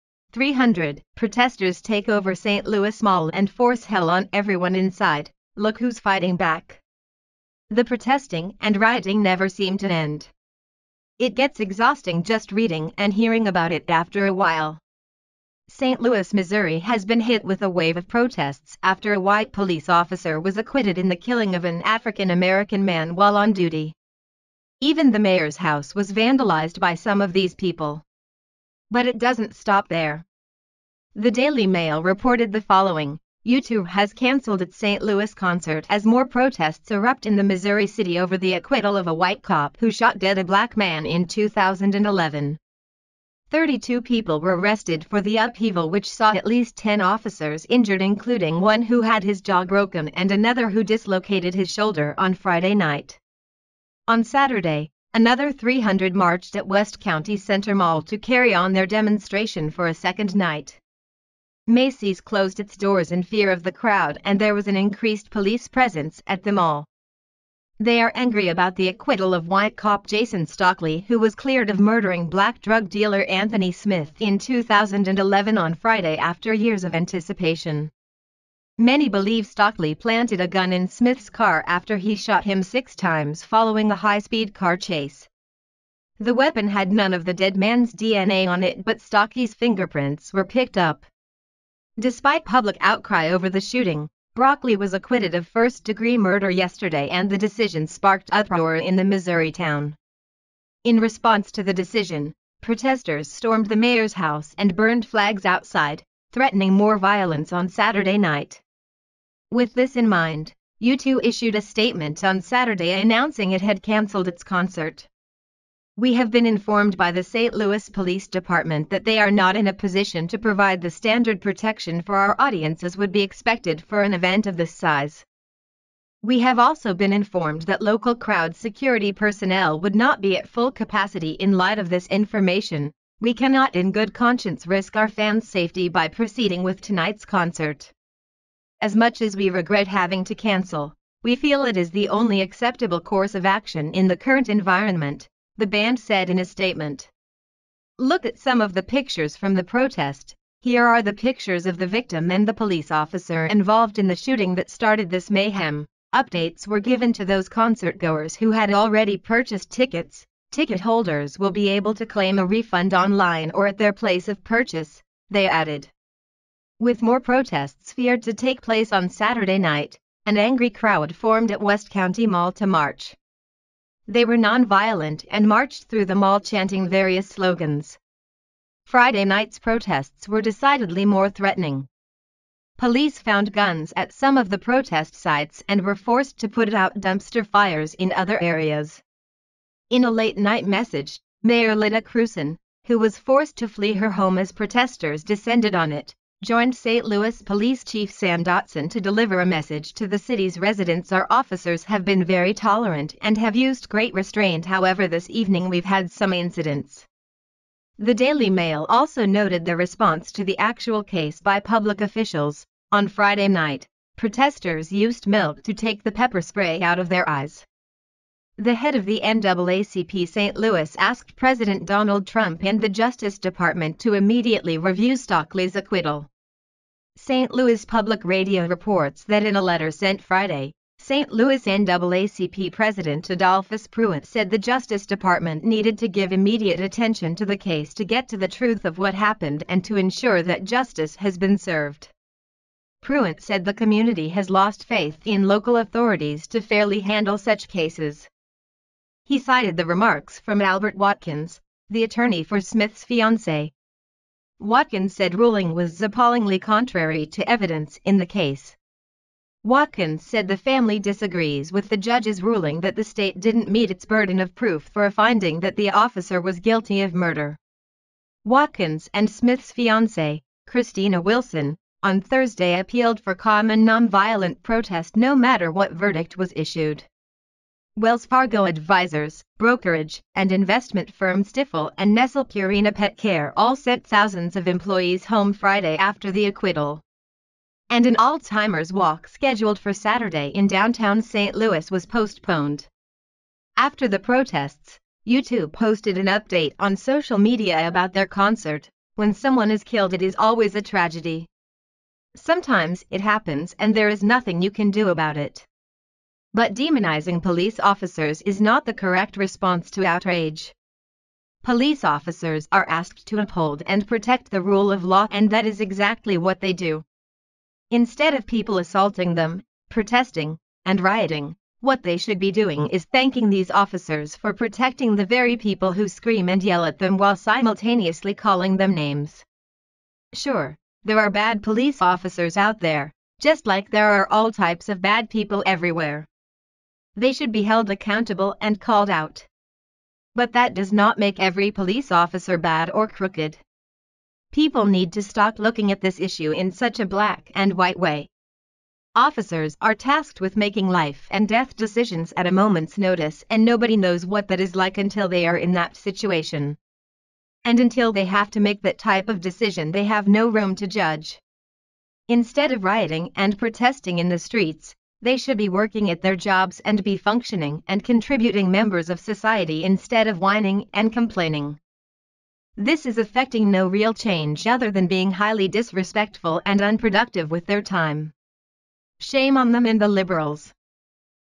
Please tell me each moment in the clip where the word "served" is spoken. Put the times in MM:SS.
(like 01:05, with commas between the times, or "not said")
04:01.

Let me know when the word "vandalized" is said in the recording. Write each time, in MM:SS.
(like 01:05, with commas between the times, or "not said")
00:26.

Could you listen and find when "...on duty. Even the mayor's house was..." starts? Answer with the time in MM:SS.
00:23.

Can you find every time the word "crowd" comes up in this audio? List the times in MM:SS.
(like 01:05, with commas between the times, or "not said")
01:03, 02:08, 02:50.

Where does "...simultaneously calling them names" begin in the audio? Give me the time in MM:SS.
05:27.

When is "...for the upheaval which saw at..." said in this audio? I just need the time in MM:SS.
00:45.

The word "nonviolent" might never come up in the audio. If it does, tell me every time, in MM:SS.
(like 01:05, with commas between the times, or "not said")
02:54, 04:33.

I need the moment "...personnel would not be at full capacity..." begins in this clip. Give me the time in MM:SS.
02:09.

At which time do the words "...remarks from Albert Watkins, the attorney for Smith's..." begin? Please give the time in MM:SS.
04:09.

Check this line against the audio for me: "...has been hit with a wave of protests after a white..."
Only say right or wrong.
right.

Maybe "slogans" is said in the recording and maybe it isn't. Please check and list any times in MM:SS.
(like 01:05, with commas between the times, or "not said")
02:57.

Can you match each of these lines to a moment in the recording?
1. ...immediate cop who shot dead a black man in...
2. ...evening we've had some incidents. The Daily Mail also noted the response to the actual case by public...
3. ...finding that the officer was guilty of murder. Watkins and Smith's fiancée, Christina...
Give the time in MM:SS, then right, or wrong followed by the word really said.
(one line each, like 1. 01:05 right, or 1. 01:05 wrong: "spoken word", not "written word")
1. 00:39 wrong: "white", not "immediate"
2. 03:25 right
3. 04:25 right.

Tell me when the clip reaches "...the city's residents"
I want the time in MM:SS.
03:20.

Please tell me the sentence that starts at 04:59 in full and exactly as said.
When someone is killed it is always a tragedy.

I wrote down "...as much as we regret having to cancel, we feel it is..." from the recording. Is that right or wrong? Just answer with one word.
right.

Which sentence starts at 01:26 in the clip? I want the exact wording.
The weapon had none of the dead man's DNA on it but Stockley's fingerprints were picked up.